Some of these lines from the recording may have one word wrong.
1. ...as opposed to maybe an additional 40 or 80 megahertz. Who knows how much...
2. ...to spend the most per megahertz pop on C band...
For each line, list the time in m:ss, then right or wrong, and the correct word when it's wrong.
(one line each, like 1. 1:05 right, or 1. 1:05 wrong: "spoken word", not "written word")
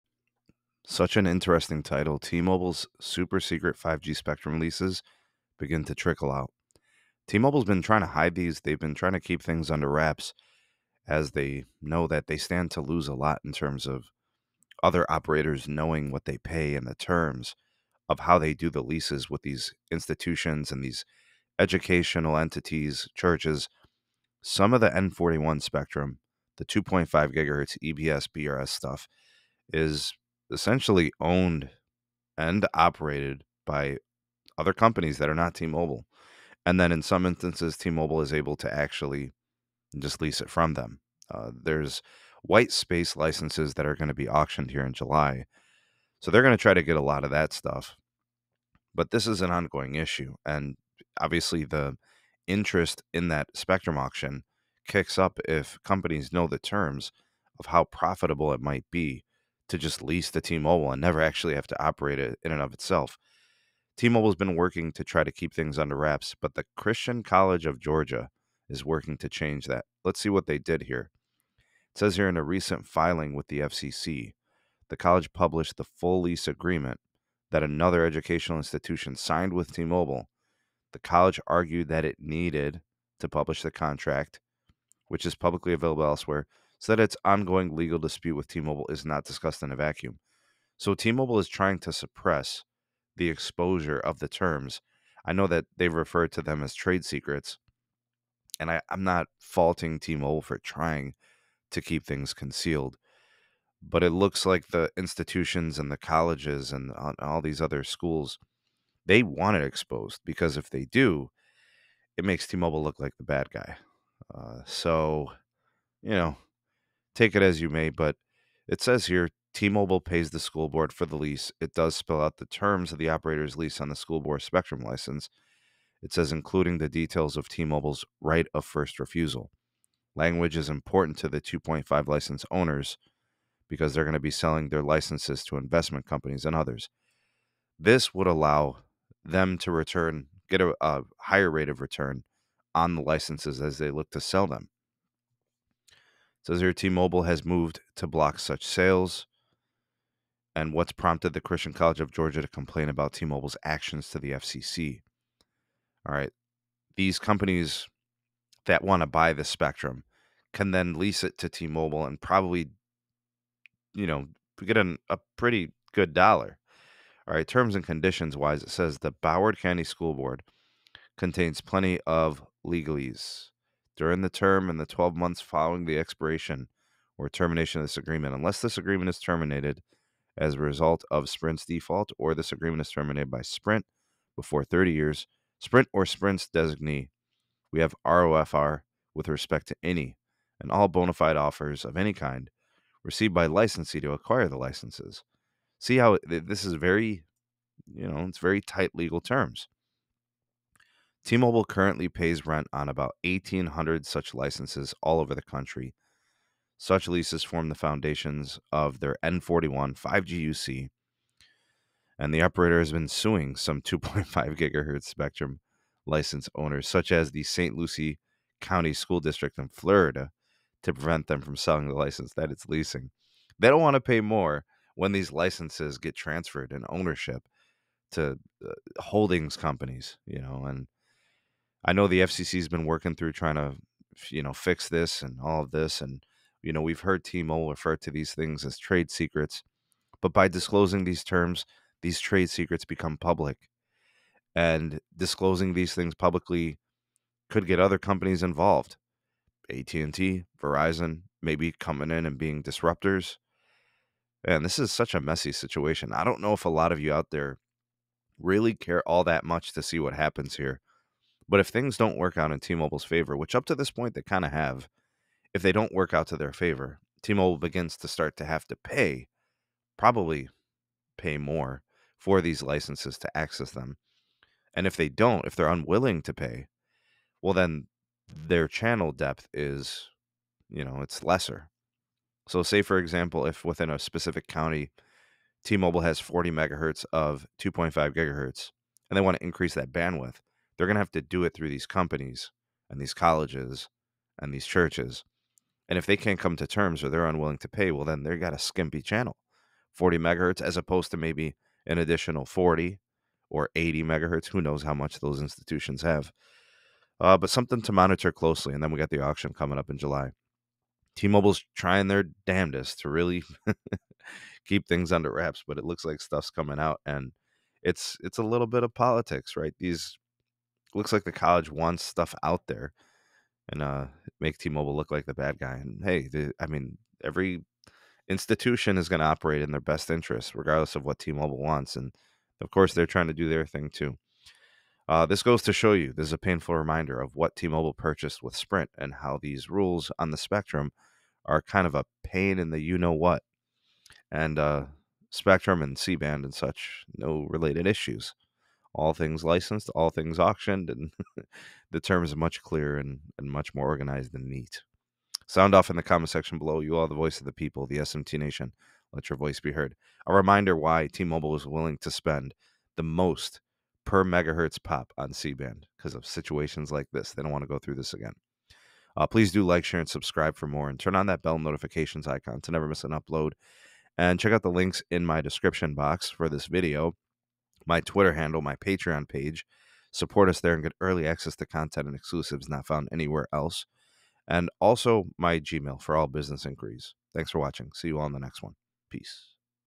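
1. 5:00 right
2. 6:01 right.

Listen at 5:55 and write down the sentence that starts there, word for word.
Sound off in the comment section below.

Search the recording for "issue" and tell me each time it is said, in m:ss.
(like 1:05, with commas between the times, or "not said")
0:49, 5:47.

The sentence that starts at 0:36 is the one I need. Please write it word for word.
And then in some instances, T-Mobile is able to actually just lease it from them.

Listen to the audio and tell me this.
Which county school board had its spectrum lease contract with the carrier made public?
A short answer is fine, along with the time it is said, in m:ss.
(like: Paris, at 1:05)
Broward County, at 2:49.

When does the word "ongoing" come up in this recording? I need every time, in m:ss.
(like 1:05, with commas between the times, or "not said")
0:49, 1:27.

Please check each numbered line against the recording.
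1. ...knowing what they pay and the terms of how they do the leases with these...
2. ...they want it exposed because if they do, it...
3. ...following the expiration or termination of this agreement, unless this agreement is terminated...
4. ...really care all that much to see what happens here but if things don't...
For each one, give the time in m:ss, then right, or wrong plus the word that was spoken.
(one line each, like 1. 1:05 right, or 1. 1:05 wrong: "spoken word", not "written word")
1. 0:15 right
2. 1:49 right
3. 2:55 right
4. 4:18 right.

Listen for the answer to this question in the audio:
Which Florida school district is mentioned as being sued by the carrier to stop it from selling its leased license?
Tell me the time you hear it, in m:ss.
3:37.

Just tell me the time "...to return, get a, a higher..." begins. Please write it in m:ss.
2:19.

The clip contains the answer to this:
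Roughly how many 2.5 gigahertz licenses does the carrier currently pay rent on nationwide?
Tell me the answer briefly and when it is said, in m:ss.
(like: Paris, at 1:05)
1,800, at 3:23.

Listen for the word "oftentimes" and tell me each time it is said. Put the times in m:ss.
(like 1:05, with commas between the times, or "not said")
not said.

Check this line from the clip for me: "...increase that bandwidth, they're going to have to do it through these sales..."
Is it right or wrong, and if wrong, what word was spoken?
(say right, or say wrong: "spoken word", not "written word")
wrong: "companies", not "sales".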